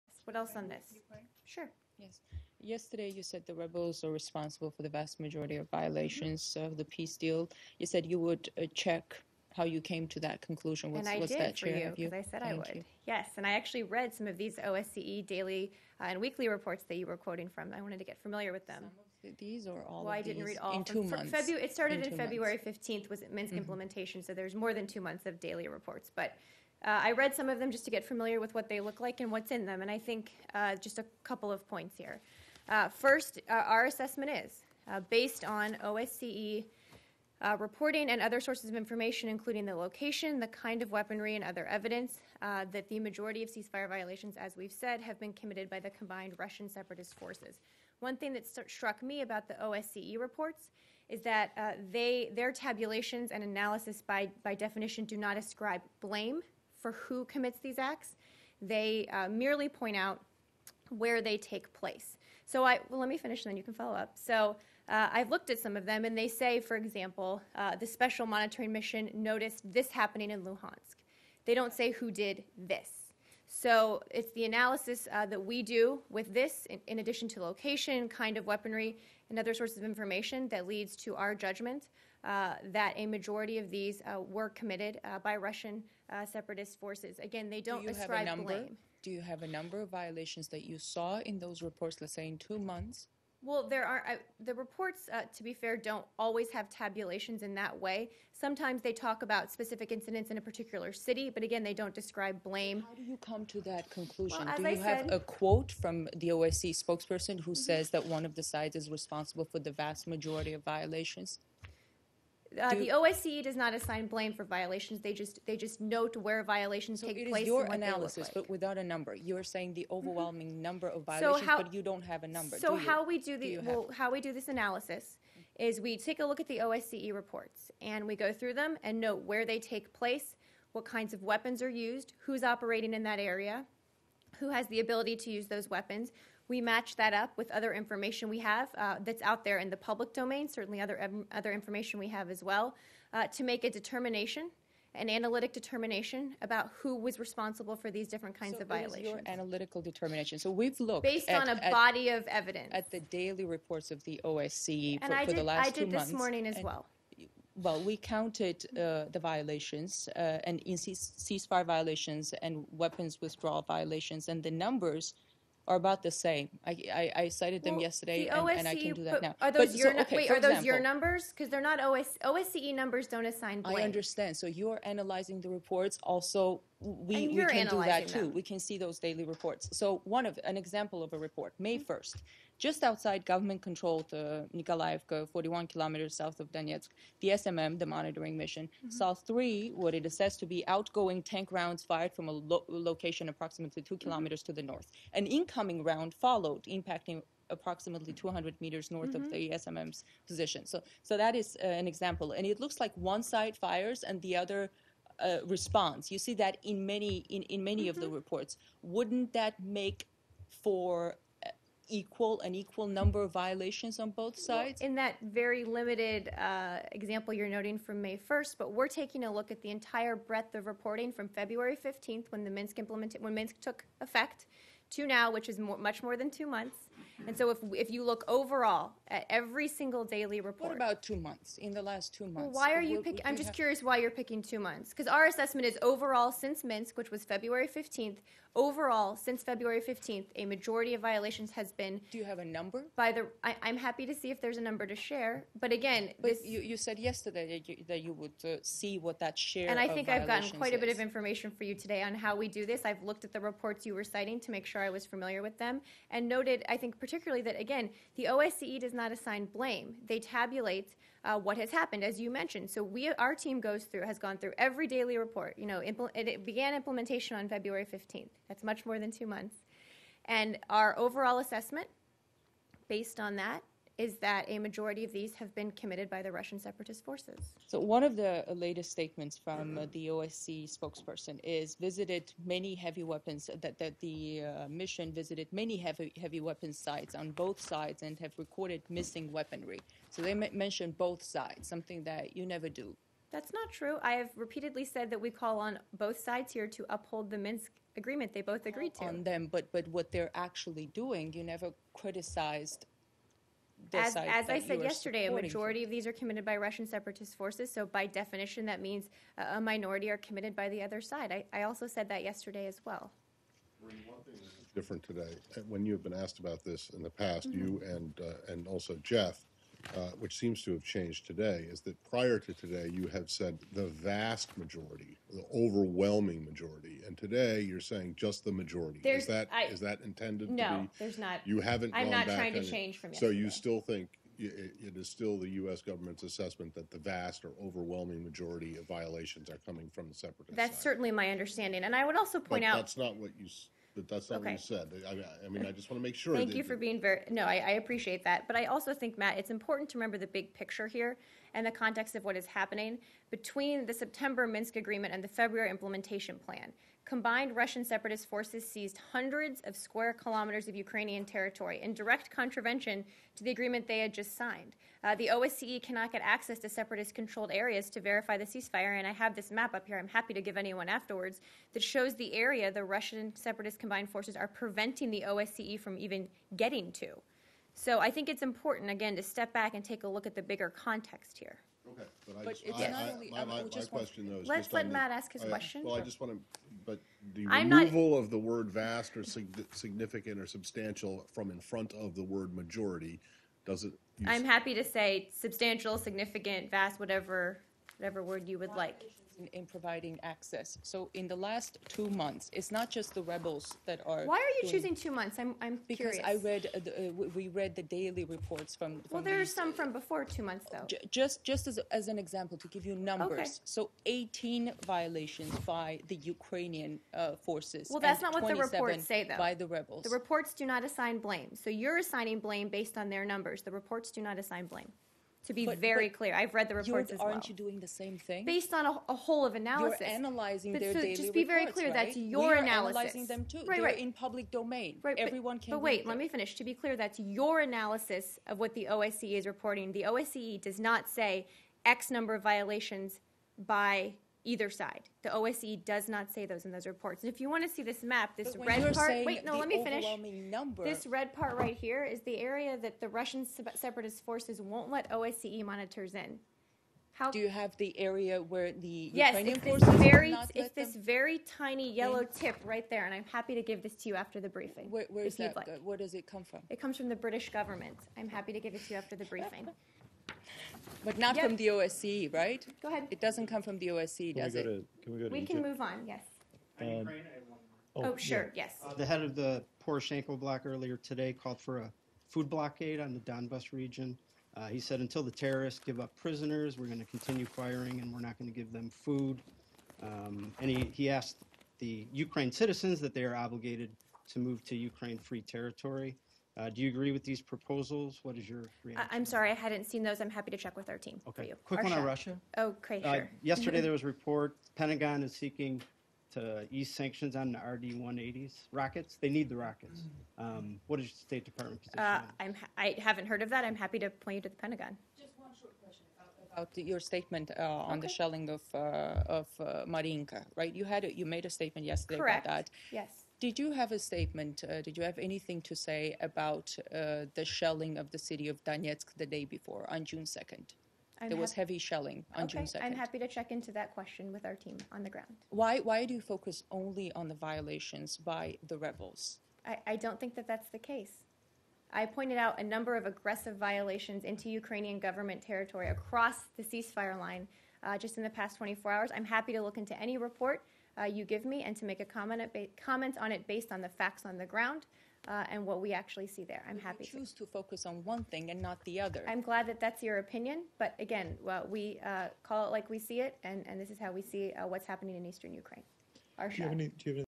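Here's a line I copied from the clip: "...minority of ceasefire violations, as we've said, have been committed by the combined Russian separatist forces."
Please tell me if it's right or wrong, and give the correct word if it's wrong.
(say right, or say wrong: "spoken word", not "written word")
wrong: "majority", not "minority".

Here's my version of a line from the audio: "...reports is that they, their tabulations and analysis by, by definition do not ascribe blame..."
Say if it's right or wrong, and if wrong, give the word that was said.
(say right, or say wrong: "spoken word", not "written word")
right.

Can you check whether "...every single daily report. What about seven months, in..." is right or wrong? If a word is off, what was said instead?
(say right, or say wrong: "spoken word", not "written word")
wrong: "two", not "seven".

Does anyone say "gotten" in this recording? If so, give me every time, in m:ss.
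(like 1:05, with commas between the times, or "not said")
4:10.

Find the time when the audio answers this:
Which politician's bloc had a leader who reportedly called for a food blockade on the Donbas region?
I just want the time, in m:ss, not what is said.
7:59.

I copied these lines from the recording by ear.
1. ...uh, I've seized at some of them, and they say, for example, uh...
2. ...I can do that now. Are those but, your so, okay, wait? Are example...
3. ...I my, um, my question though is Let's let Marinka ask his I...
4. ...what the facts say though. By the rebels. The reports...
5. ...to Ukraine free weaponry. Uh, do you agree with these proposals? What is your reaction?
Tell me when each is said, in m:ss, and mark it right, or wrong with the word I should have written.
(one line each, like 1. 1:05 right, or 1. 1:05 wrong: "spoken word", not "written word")
1. 1:04 wrong: "looked", not "seized"
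2. 2:48 right
3. 6:23 wrong: "Matt", not "Marinka"
4. 6:58 wrong: "reports", not "facts"
5. 8:14 wrong: "territory", not "weaponry".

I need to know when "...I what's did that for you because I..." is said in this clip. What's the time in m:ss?
0:11.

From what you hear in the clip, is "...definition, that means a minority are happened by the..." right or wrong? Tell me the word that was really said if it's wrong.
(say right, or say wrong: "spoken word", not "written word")
wrong: "committed", not "happened".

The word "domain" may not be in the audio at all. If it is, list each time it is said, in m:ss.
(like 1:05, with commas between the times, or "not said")
2:20, 7:14.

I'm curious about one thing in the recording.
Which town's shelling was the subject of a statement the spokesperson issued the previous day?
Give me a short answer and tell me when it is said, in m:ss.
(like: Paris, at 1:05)
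Marinka, at 8:39.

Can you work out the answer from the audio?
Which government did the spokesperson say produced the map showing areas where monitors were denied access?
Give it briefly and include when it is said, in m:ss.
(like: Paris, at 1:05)
British government, at 7:47.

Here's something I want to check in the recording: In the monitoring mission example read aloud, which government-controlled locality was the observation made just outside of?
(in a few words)
Nikolaevka.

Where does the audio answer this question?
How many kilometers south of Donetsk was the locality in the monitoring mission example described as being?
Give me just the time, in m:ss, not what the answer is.
3:05.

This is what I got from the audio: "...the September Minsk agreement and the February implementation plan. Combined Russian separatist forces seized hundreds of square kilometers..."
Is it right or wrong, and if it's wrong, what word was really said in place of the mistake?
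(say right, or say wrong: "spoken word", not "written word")
right.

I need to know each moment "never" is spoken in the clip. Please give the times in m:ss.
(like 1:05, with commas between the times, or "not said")
4:52, 5:01.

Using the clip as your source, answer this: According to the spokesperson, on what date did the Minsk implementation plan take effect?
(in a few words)
February 15th.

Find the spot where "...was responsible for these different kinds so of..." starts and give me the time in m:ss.
2:26.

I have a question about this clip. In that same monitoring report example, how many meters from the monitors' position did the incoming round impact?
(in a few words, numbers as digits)
200.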